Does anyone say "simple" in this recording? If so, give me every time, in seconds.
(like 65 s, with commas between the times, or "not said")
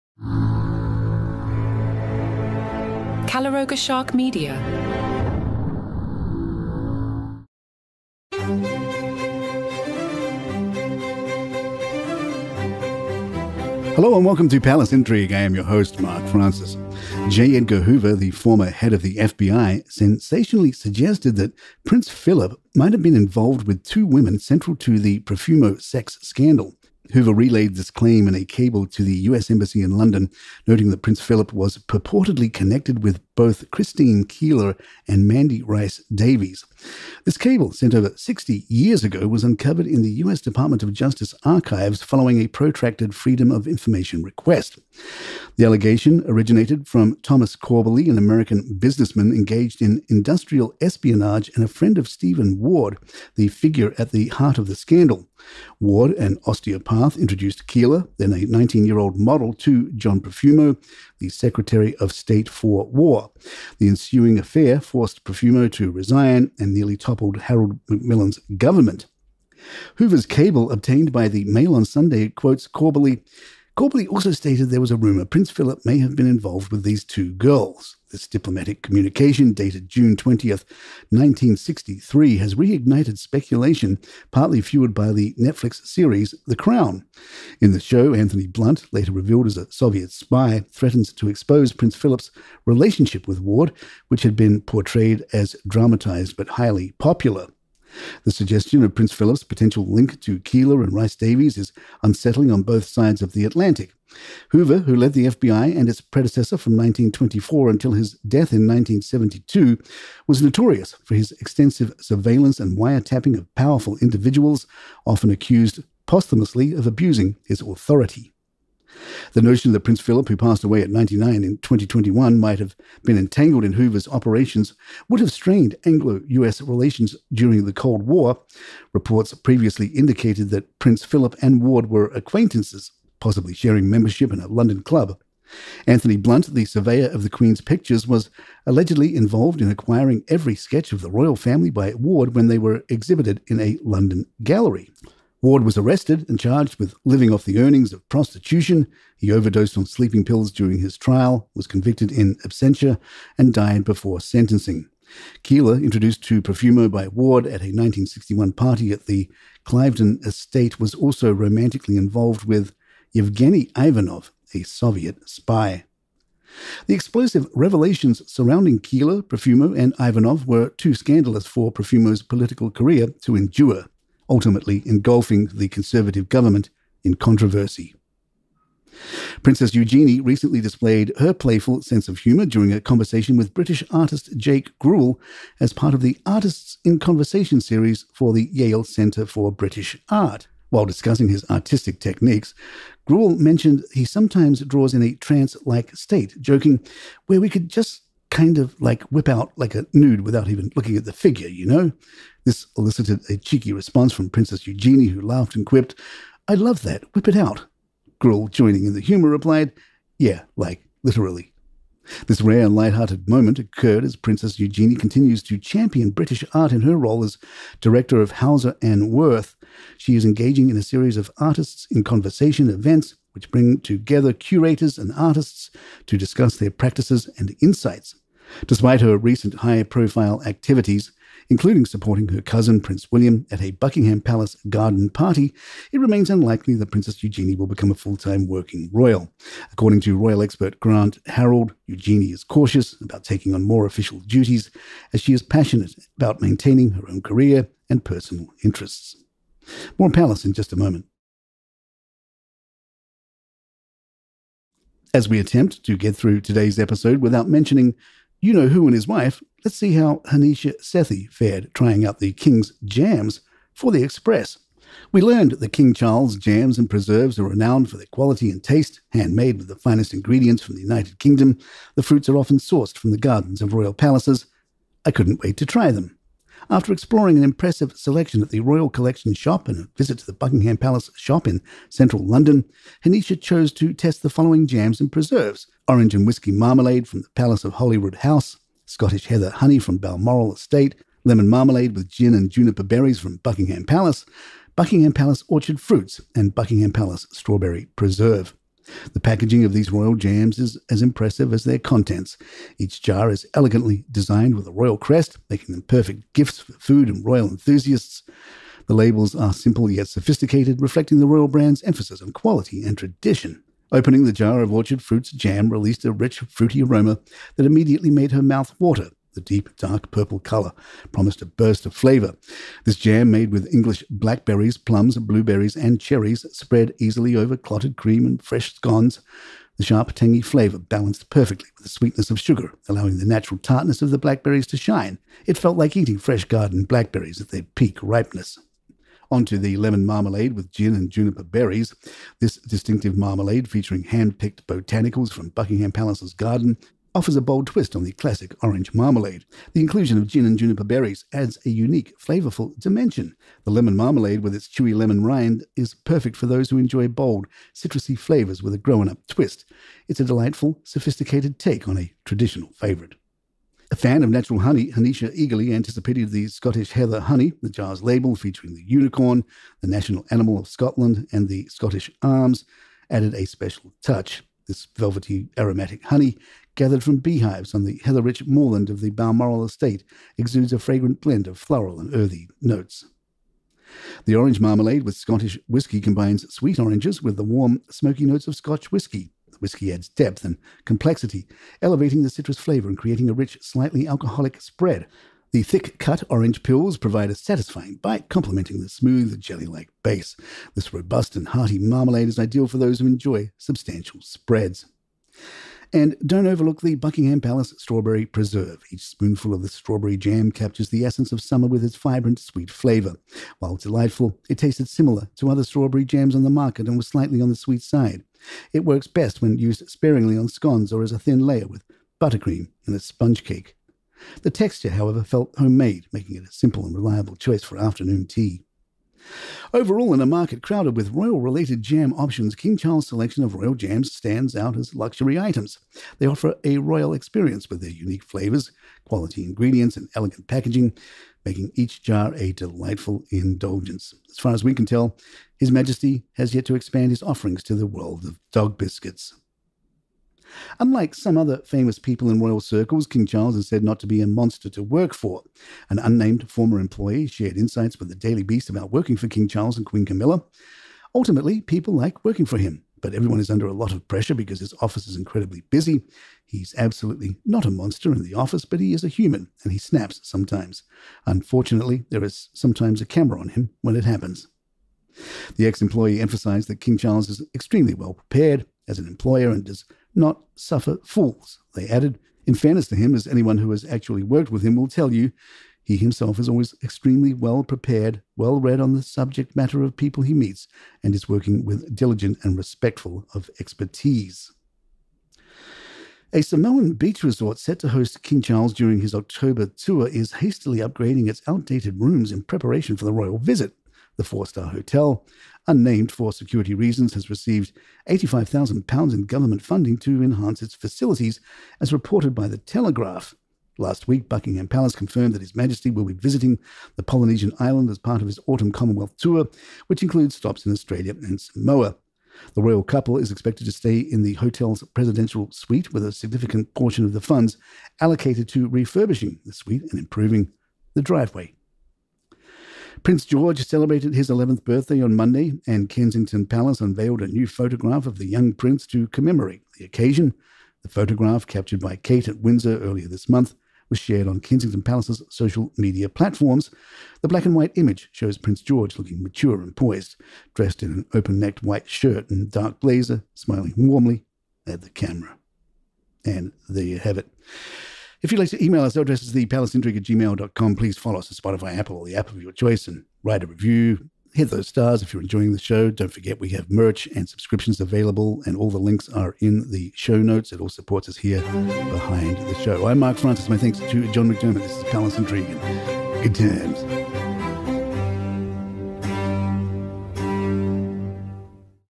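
309 s, 426 s.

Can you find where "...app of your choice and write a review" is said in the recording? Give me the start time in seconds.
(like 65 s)
562 s.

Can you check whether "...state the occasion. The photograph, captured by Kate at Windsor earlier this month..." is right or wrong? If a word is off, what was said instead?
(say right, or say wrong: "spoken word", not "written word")
wrong: "commemorate", not "state".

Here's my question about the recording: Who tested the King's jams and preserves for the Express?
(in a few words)
Hanisha Sethi.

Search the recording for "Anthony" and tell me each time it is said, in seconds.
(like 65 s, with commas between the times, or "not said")
88 s, 135 s.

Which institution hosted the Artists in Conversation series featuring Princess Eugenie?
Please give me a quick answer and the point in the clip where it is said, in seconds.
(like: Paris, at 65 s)
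Yale Centre for British Art, at 188 s.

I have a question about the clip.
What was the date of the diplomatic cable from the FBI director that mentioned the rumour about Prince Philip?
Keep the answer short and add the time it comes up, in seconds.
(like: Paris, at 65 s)
June 20, 1963, at 79 s.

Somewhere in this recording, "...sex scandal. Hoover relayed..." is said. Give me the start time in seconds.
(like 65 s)
25 s.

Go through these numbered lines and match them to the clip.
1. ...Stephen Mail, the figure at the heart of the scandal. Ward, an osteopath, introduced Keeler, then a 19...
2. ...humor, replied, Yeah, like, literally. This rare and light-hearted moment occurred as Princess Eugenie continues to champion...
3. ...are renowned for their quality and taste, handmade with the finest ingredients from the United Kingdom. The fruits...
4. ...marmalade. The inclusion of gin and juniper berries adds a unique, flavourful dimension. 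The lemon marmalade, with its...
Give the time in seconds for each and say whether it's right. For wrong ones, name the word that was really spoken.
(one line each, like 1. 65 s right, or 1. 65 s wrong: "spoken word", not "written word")
1. 52 s wrong: "Ward", not "Mail"
2. 209 s right
3. 267 s right
4. 348 s right.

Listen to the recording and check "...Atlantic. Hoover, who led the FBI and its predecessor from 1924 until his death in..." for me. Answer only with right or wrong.
right.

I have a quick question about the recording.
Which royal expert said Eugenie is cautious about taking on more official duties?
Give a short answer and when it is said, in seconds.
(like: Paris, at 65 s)
Grant Harold, at 240 s.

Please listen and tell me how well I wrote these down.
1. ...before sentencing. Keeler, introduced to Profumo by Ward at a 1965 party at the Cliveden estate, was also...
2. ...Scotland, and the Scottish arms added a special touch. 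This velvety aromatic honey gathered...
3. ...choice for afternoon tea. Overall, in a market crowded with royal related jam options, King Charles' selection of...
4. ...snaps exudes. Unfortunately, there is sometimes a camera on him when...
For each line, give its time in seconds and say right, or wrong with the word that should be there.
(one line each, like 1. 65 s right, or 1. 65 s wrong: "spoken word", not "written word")
1. 153 s wrong: "1961", not "1965"
2. 370 s right
3. 427 s right
4. 469 s wrong: "sometimes", not "exudes".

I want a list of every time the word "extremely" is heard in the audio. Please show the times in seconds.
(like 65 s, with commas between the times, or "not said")
477 s, 486 s.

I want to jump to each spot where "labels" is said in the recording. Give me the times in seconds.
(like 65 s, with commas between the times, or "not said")
308 s, 368 s.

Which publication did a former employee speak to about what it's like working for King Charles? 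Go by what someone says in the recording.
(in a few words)
Daily Beast.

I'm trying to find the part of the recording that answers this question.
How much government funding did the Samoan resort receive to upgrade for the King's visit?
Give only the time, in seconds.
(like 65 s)
508 s.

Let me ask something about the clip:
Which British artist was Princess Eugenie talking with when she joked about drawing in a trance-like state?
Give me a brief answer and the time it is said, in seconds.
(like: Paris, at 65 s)
Jake Grewal, at 184 s.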